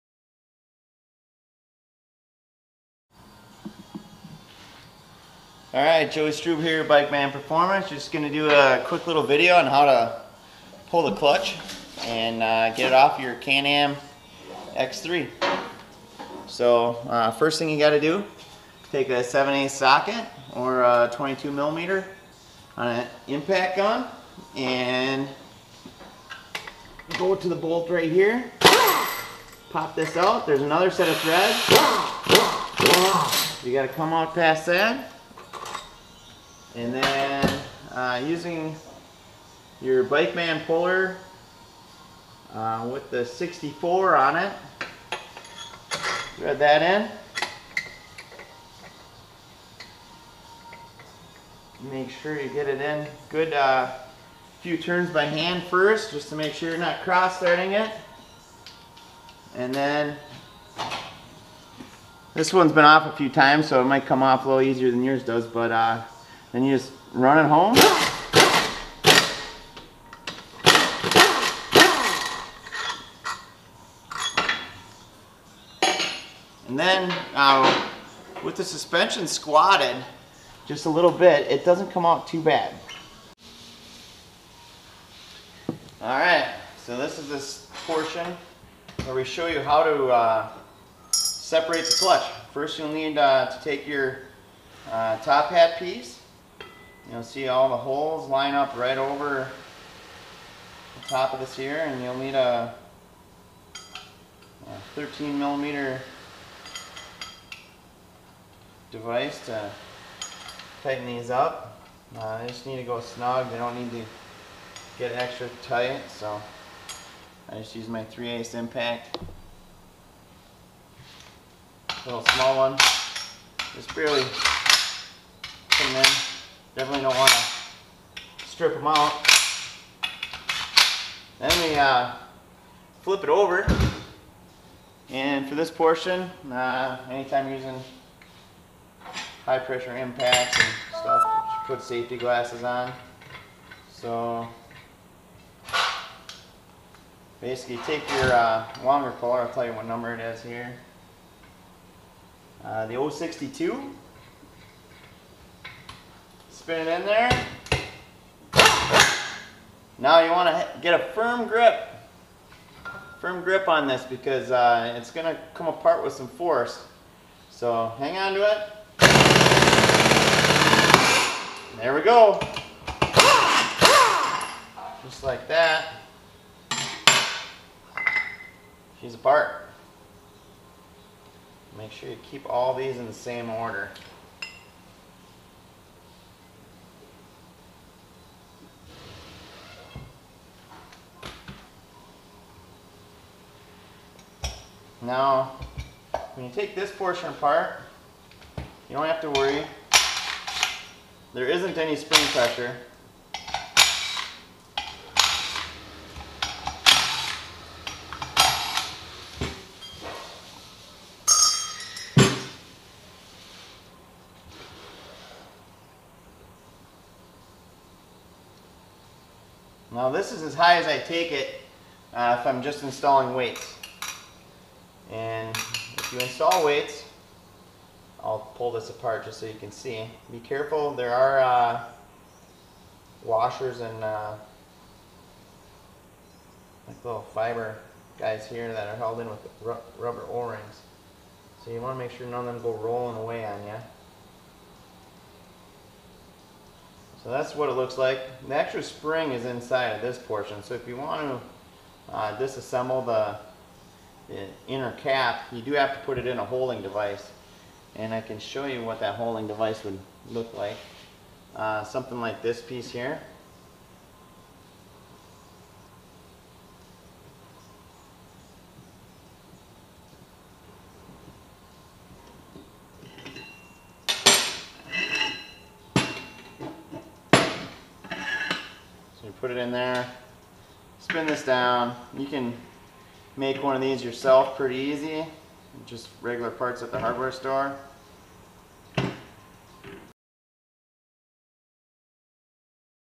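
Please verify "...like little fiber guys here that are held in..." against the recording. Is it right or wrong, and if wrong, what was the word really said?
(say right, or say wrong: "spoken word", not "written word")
right.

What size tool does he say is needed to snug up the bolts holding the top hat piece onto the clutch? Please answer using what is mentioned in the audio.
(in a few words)
13 millimeter.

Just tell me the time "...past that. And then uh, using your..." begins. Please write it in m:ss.
0:34.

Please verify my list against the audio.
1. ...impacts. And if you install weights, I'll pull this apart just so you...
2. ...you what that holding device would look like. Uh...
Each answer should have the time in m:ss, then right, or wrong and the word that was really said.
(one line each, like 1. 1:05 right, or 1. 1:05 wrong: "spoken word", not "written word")
1. 3:43 wrong: "weights", not "impacts"
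2. 4:18 right.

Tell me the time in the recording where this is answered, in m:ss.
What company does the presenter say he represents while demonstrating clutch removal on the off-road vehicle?
0:06.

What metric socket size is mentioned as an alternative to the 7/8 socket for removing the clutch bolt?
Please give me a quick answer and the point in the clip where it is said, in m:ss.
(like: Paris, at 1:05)
22 millimeter, at 0:21.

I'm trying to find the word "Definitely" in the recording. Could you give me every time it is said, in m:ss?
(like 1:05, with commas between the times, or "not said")
2:06.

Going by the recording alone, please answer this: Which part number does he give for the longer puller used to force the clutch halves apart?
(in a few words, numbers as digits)
062.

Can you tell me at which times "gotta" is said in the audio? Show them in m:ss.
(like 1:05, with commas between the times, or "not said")
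0:17, 0:33.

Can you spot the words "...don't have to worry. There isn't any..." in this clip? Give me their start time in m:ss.
3:18.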